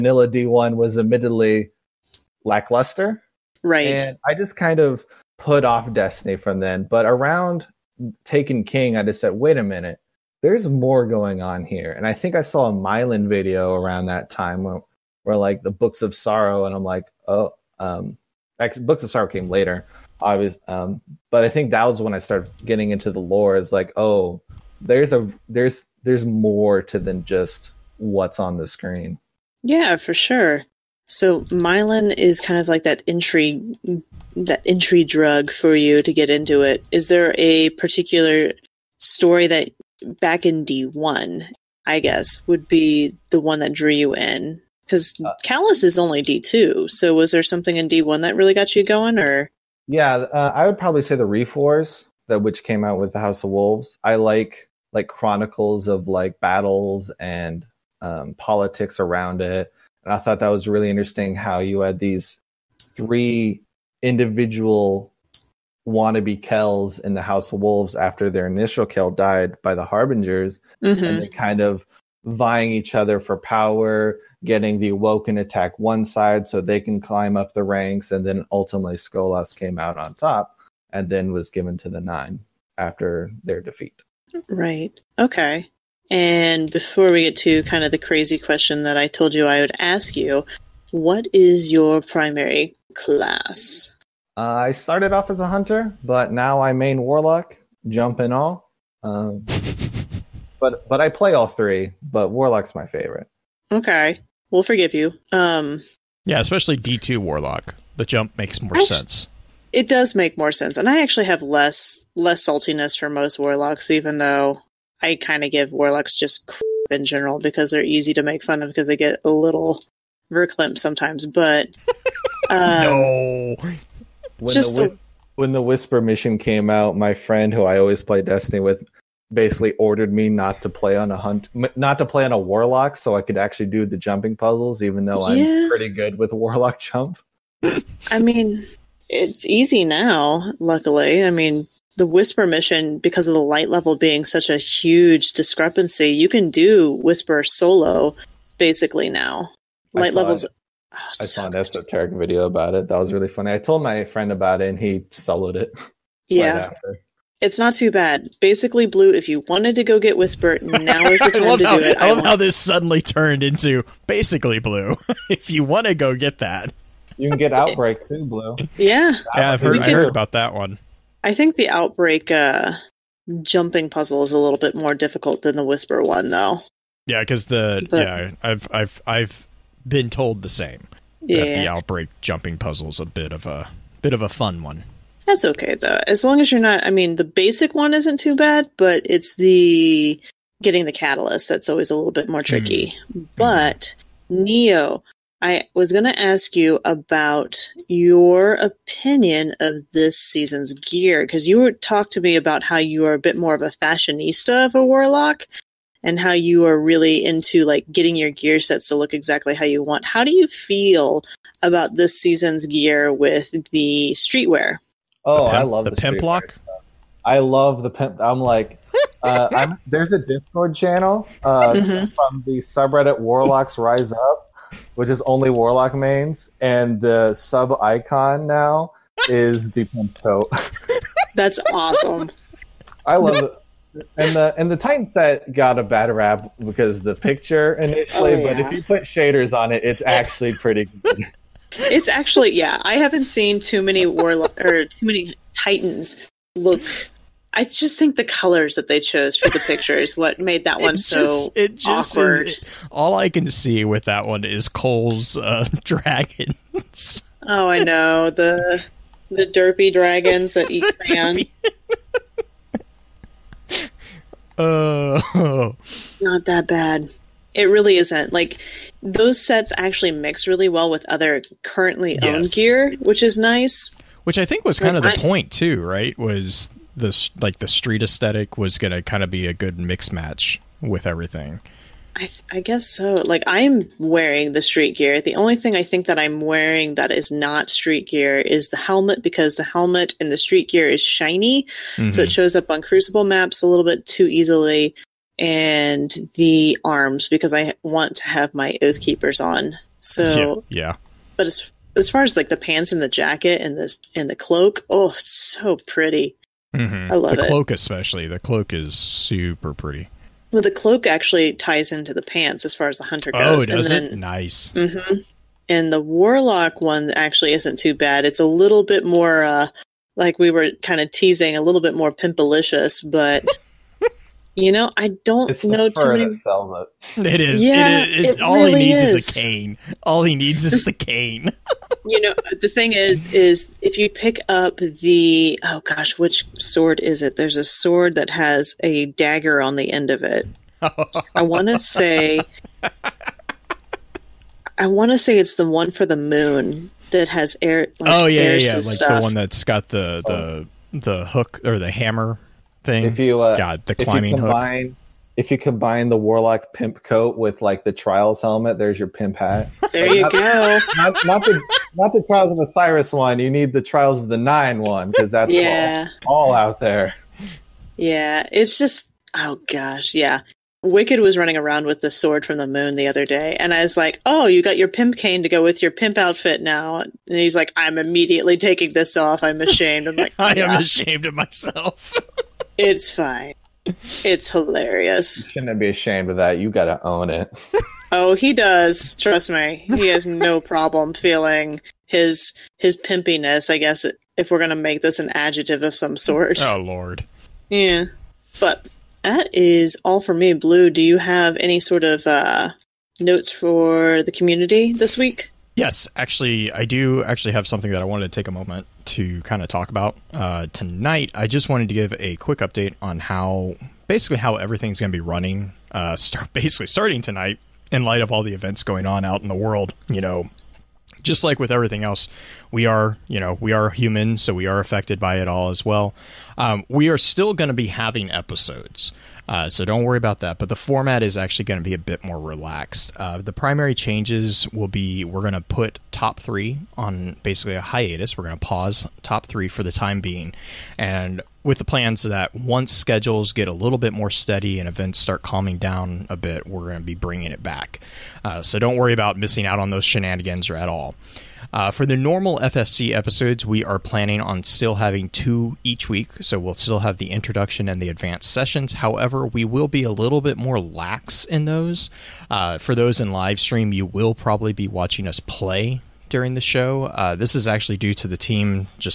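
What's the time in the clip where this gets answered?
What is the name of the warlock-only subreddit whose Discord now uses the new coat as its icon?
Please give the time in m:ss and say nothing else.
3:43.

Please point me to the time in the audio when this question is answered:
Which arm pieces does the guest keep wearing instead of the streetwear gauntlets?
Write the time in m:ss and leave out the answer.
4:58.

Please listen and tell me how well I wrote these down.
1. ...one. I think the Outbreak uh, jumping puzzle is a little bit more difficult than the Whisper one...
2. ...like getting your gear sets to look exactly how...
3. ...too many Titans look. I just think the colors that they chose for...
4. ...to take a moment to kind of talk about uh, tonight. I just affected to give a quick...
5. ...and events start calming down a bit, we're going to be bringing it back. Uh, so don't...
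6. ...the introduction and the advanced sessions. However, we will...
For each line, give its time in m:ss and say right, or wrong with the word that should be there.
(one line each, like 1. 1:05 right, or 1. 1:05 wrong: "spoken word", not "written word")
1. 2:50 right
2. 3:27 right
3. 4:04 right
4. 6:48 wrong: "wanted", not "affected"
5. 7:24 right
6. 7:37 right.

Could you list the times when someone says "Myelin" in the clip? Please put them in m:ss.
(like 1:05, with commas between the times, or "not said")
0:12, 0:31.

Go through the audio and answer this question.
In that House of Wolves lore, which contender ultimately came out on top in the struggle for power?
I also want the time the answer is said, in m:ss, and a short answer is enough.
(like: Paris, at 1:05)
Skolas, at 1:18.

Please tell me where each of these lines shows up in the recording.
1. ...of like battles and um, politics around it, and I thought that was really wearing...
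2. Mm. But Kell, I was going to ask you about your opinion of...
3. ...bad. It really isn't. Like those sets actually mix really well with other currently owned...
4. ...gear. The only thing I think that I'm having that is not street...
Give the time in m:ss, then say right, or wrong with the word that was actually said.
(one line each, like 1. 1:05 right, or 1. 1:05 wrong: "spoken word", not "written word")
1. 0:55 wrong: "interesting", not "wearing"
2. 3:13 wrong: "Neo", not "Kell"
3. 4:26 right
4. 4:44 wrong: "wearing", not "having".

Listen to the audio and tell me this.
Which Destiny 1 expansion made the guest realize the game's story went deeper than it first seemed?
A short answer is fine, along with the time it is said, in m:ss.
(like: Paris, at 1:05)
Taken King, at 0:08.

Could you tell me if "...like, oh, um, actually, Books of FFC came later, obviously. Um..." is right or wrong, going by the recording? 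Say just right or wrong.
wrong.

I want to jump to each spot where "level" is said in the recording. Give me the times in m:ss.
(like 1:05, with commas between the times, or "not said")
2:23, 2:30.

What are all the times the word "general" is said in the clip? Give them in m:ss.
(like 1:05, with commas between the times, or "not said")
1:57.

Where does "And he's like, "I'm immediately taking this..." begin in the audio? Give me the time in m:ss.
6:17.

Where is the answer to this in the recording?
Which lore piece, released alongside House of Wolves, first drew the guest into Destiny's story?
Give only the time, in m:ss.
0:51.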